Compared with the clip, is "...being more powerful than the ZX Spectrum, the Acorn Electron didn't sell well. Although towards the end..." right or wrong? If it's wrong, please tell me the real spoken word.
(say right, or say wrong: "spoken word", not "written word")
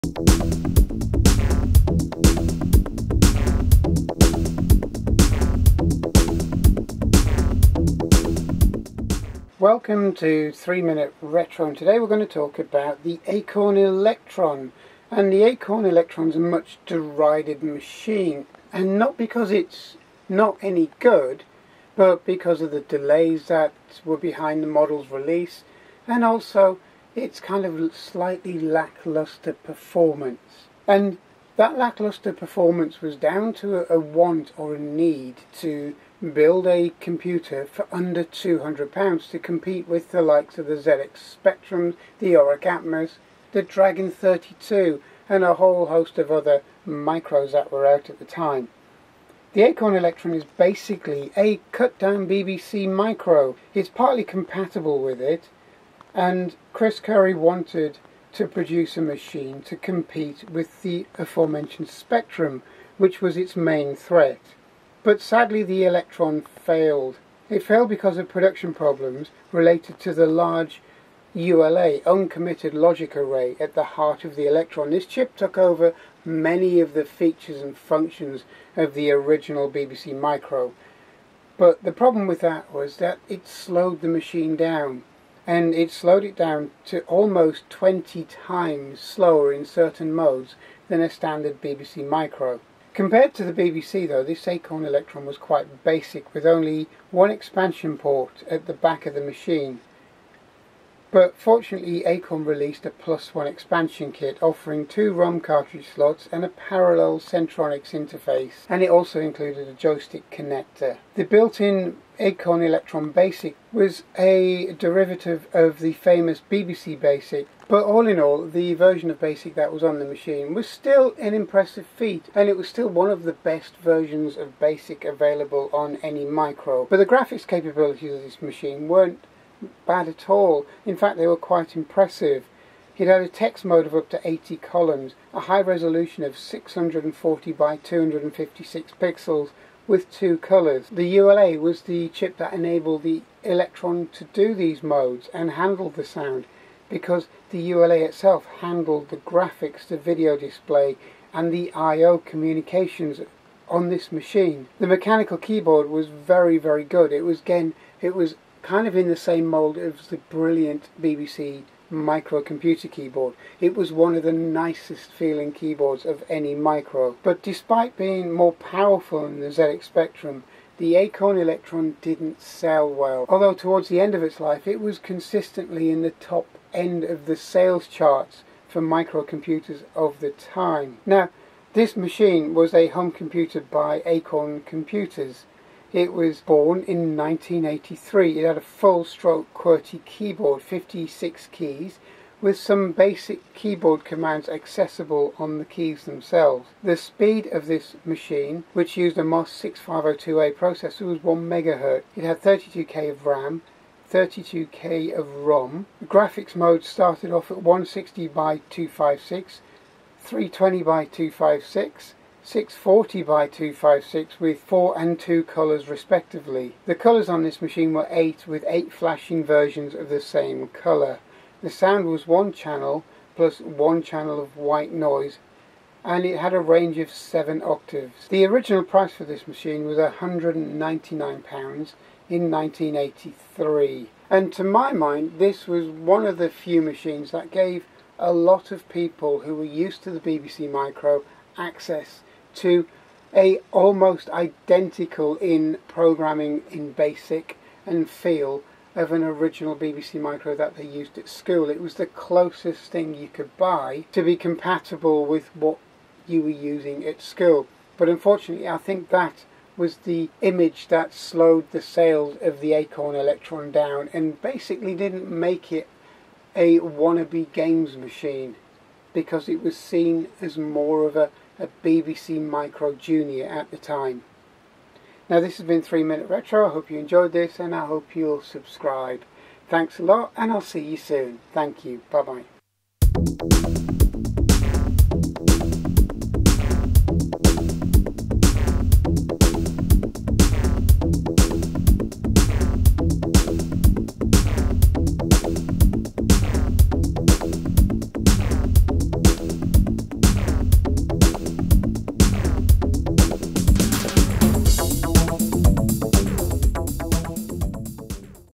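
right.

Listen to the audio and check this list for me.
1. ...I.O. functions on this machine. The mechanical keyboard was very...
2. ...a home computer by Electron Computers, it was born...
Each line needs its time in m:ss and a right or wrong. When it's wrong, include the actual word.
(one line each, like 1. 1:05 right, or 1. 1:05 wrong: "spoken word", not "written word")
1. 2:31 wrong: "communications", not "functions"
2. 3:02 wrong: "Acorn", not "Electron".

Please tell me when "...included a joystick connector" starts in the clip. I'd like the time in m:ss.
1:49.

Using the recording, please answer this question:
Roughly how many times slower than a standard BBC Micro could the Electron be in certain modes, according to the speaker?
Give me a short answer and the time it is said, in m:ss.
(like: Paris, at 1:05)
20, at 1:27.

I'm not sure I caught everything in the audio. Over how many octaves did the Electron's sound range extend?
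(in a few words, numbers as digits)
7.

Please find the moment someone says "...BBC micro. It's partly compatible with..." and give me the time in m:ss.
0:52.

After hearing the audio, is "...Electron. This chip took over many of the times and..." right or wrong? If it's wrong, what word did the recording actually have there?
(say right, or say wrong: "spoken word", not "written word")
wrong: "features", not "times".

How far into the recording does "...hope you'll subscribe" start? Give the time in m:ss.
4:37.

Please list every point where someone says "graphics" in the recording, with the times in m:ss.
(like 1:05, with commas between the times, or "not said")
2:07, 2:29, 3:26.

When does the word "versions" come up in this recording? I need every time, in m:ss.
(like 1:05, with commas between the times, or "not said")
1:58, 2:03, 3:39.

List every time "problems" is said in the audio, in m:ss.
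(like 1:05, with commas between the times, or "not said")
1:08, 1:21.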